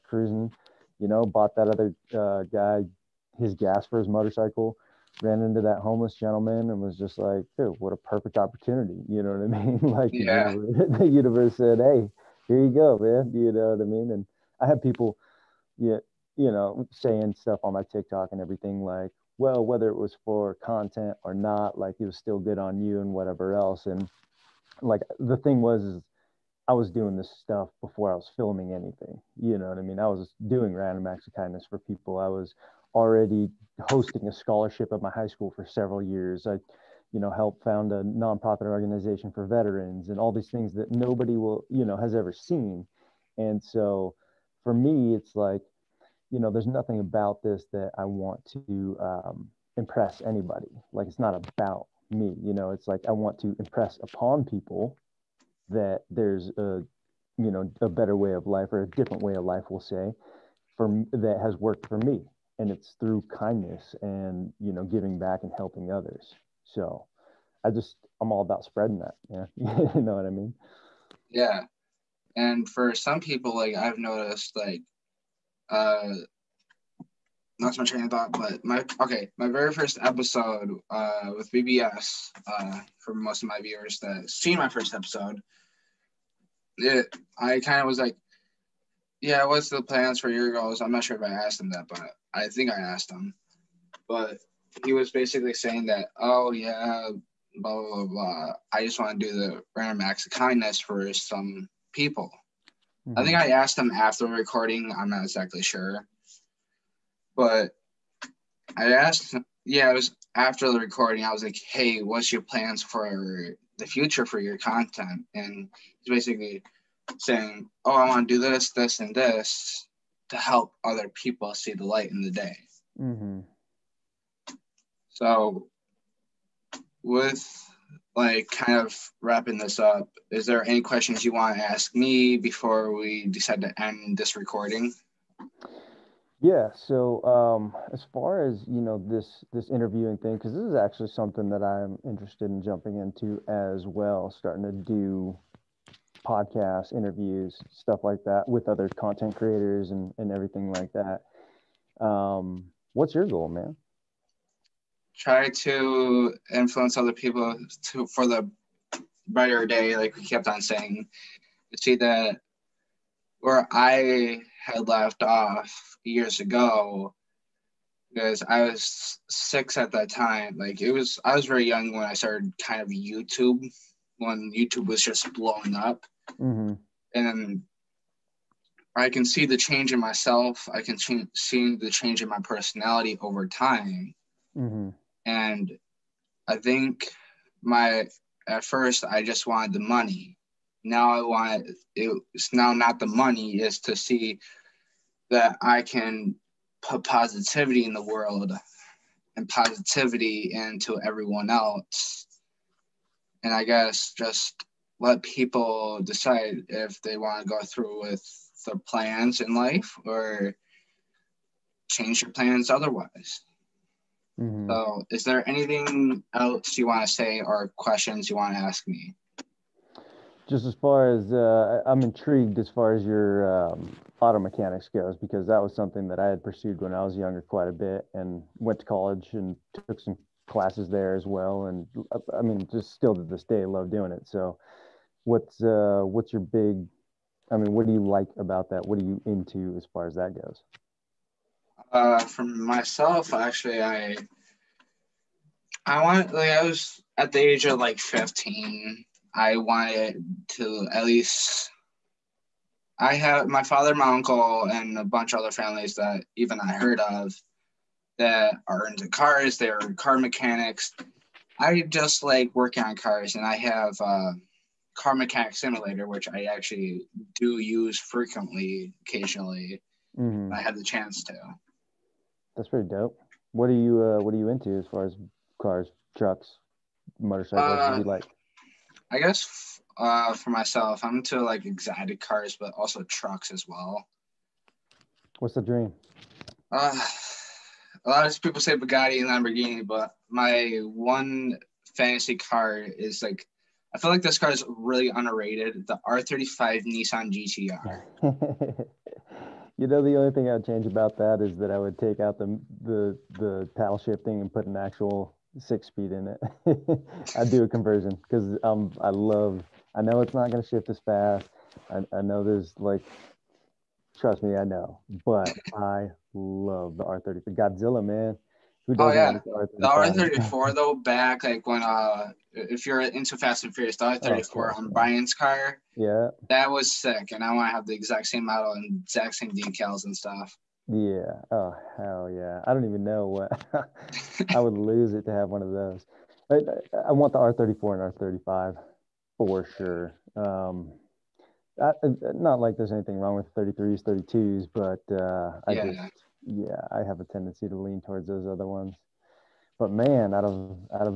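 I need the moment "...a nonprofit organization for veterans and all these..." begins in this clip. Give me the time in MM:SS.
00:37.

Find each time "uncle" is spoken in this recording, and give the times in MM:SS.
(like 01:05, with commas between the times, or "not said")
04:14.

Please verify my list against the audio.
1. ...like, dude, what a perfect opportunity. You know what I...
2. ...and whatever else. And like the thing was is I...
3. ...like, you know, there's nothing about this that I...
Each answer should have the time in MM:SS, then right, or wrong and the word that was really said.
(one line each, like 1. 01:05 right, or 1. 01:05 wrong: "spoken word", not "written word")
1. 00:07 right
2. 00:23 right
3. 00:45 right.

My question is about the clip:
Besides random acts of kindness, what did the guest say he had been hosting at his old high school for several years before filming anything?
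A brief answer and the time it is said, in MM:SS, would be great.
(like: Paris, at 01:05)
A scholarship, at 00:34.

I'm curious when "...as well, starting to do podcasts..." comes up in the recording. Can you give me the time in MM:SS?
02:23.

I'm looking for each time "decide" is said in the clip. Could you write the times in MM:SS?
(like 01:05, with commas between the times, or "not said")
02:13, 03:26.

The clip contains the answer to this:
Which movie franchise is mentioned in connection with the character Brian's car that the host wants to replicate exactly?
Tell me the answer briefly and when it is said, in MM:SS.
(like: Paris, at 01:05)
Fast and Furious, at 05:23.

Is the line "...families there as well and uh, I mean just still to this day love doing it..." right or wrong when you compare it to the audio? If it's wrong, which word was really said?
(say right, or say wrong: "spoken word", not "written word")
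wrong: "classes", not "families".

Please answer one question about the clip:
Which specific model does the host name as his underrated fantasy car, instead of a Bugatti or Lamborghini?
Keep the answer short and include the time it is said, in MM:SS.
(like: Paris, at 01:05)
R35 Nissan GTR, at 04:56.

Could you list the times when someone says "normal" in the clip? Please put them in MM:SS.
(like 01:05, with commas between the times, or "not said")
not said.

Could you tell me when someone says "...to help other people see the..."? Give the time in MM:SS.
02:00.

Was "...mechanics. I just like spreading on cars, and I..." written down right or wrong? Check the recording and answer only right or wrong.
wrong.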